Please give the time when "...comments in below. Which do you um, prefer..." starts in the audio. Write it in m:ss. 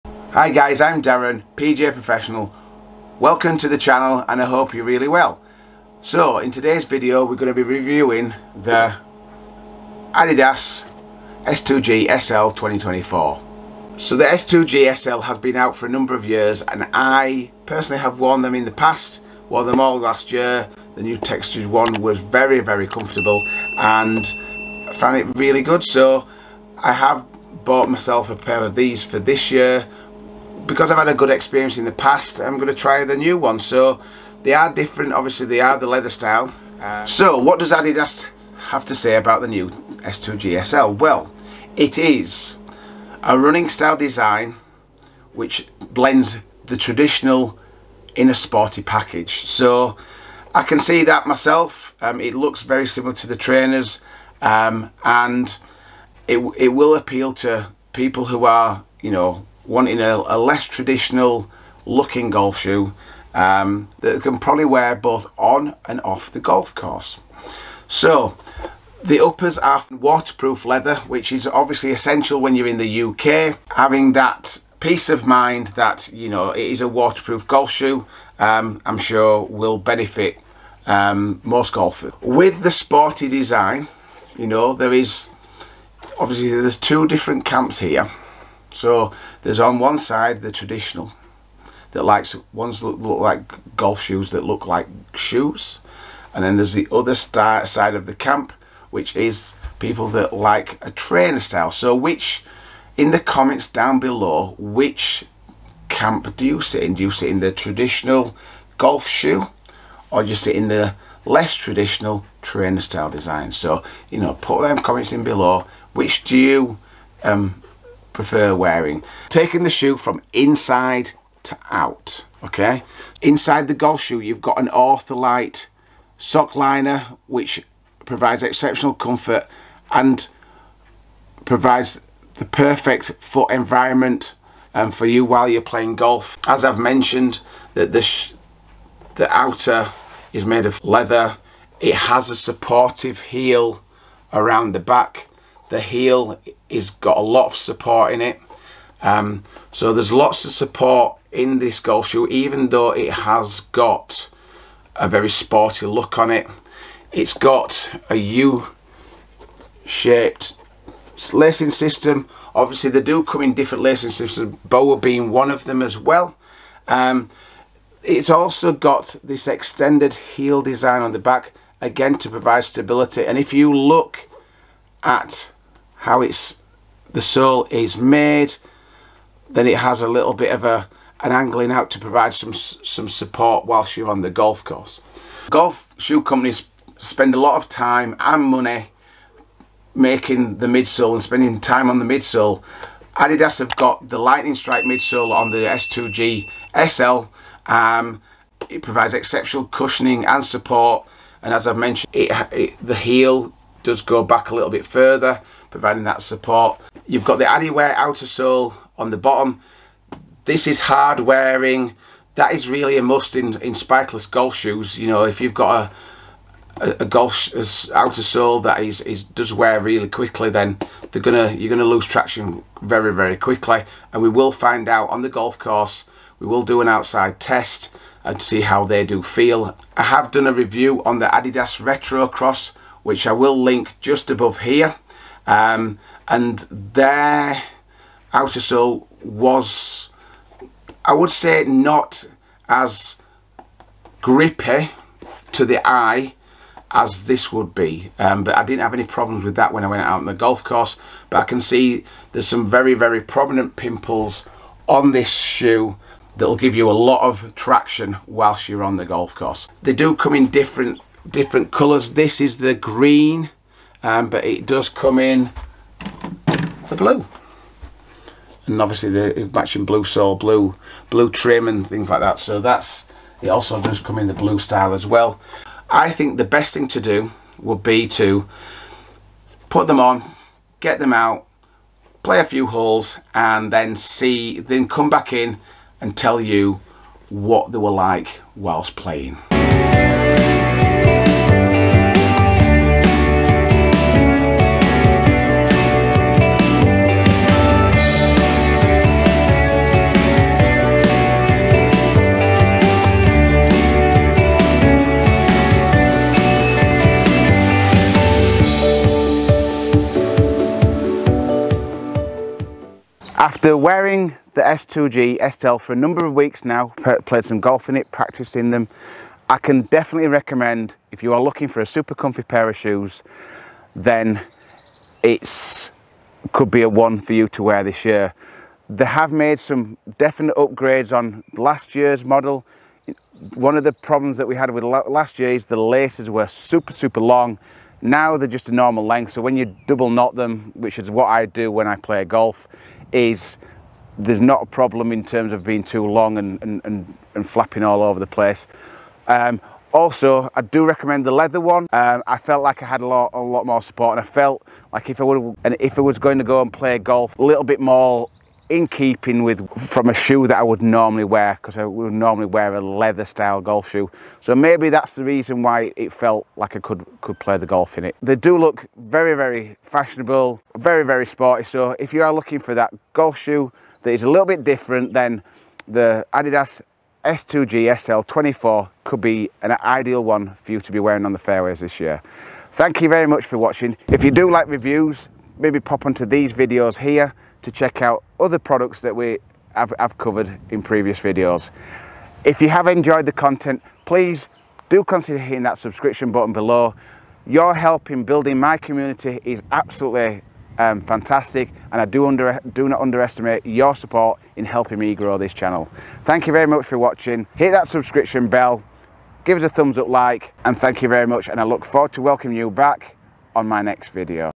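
1:54.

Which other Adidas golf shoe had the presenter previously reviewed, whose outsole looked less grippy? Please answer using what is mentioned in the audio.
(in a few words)
Retro Cross.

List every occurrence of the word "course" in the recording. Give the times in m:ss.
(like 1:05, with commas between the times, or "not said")
1:06, 3:04, 3:45, 4:10, 4:19.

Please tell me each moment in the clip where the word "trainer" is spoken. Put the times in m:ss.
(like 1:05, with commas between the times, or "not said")
0:53, 1:40, 1:52.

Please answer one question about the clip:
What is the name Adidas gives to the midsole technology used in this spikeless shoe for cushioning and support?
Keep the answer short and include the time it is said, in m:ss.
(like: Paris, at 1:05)
Lightning Strike, at 3:14.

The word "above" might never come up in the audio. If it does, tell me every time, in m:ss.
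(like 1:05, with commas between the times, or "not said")
3:54.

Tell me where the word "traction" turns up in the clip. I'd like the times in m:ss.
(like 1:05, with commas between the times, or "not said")
3:42, 4:17.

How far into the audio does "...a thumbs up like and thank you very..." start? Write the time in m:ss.
6:49.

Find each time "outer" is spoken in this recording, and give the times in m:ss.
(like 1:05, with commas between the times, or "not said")
2:19, 3:27, 3:37, 3:58.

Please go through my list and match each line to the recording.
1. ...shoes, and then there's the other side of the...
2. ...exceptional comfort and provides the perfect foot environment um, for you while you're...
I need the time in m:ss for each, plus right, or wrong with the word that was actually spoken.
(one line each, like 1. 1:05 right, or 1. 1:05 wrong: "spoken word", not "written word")
1. 1:35 right
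2. 2:08 right.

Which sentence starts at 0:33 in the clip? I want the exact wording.
So they are different, obviously they are the leather style.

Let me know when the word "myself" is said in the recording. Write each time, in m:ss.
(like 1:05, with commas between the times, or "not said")
0:27, 0:51.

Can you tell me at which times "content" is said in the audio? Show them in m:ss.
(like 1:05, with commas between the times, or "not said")
6:33.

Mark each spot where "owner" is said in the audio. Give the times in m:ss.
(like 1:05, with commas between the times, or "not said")
not said.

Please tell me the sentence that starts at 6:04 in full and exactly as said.
So maybe that's the reason why it felt like I could, could play the golf in it.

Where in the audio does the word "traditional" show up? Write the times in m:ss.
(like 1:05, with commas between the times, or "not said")
0:46, 1:00, 1:30, 1:47, 1:51.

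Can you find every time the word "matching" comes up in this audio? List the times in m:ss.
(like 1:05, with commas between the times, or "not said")
4:29.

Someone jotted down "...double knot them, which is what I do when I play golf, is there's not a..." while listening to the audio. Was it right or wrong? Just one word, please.
right.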